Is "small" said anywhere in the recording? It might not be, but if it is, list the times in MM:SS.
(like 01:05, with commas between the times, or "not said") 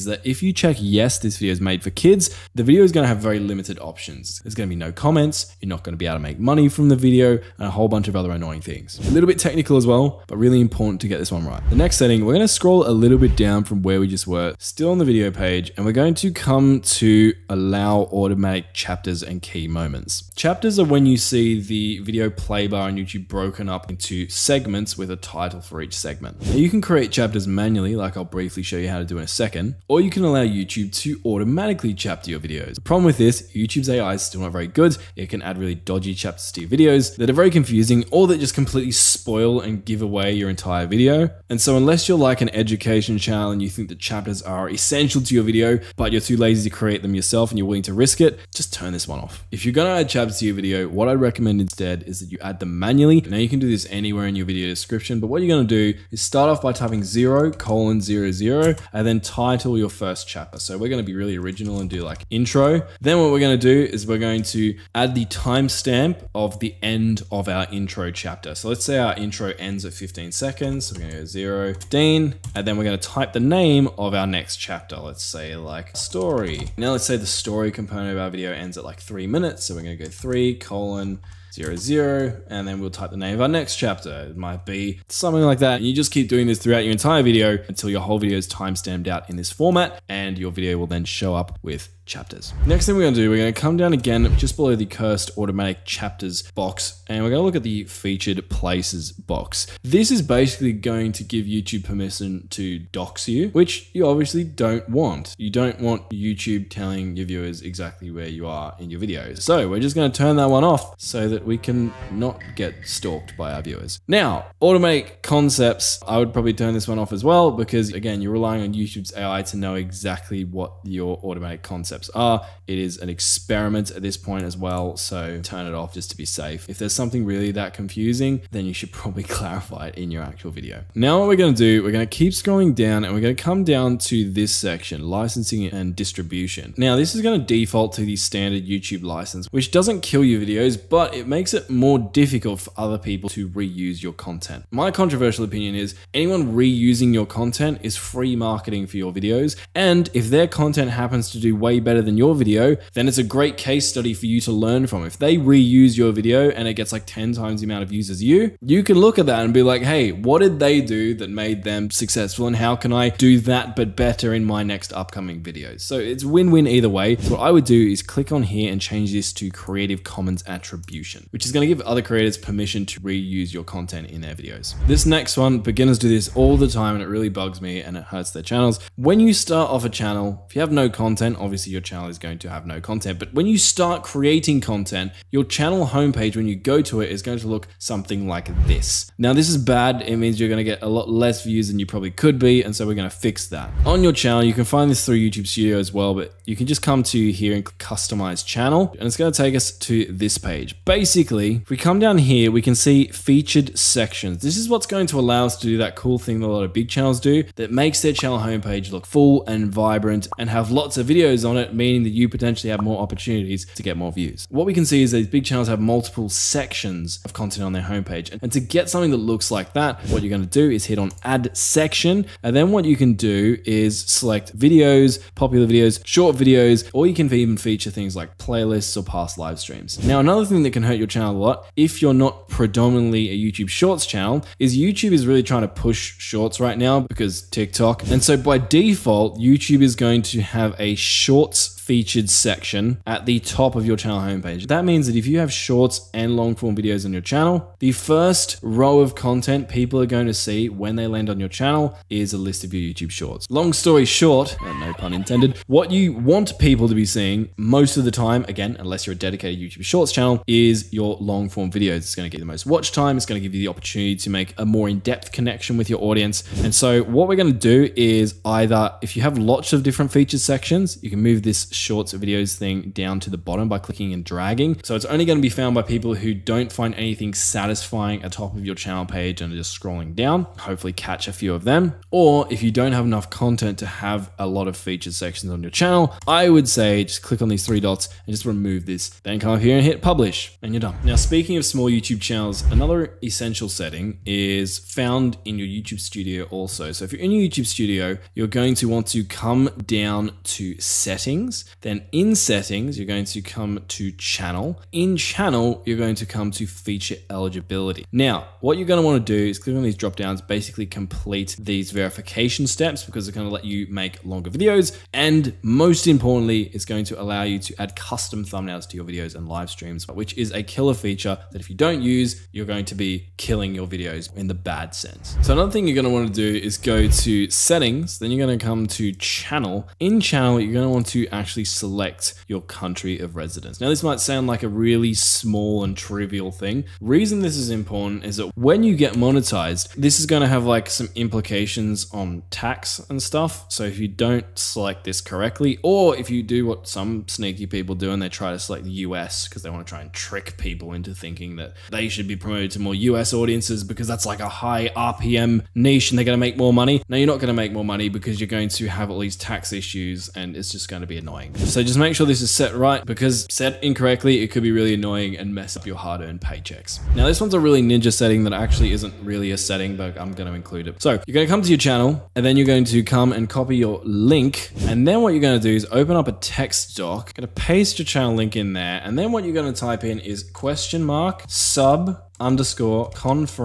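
04:51, 05:35.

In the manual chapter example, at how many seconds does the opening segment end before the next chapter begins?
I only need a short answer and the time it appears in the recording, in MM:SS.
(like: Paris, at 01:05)
15, at 01:09.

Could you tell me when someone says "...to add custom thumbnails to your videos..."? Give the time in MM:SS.
05:17.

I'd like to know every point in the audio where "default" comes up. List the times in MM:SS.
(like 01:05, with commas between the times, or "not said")
02:17, 03:58.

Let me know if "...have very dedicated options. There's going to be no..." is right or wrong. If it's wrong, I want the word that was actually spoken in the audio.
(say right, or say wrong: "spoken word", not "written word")
wrong: "limited", not "dedicated".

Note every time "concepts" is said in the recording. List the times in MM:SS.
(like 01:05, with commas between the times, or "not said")
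01:55, 02:01.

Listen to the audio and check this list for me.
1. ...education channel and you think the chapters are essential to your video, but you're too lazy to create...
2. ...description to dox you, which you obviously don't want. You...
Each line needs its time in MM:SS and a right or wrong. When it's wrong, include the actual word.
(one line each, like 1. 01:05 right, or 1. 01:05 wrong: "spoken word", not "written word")
1. 00:42 right
2. 01:41 wrong: "permission", not "description".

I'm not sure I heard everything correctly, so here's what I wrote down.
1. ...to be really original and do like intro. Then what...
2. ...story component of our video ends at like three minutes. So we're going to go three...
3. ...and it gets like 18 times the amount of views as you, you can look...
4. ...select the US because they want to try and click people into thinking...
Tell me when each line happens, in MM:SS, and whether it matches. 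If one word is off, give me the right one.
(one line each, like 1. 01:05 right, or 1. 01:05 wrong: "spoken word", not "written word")
1. 01:01 right
2. 01:17 right
3. 02:36 wrong: "10", not "18"
4. 05:48 wrong: "trick", not "click".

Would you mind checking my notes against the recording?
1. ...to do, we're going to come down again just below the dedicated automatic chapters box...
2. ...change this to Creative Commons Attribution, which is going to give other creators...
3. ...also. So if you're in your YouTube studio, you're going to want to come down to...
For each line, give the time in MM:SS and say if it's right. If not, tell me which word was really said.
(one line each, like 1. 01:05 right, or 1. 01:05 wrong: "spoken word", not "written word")
1. 01:33 wrong: "cursed", not "dedicated"
2. 02:48 right
3. 04:56 right.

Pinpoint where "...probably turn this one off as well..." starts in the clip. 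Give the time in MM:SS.
01:56.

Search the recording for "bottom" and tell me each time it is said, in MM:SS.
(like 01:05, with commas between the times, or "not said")
04:33.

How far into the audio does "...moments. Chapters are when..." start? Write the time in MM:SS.
00:19.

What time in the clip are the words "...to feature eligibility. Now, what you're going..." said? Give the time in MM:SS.
05:06.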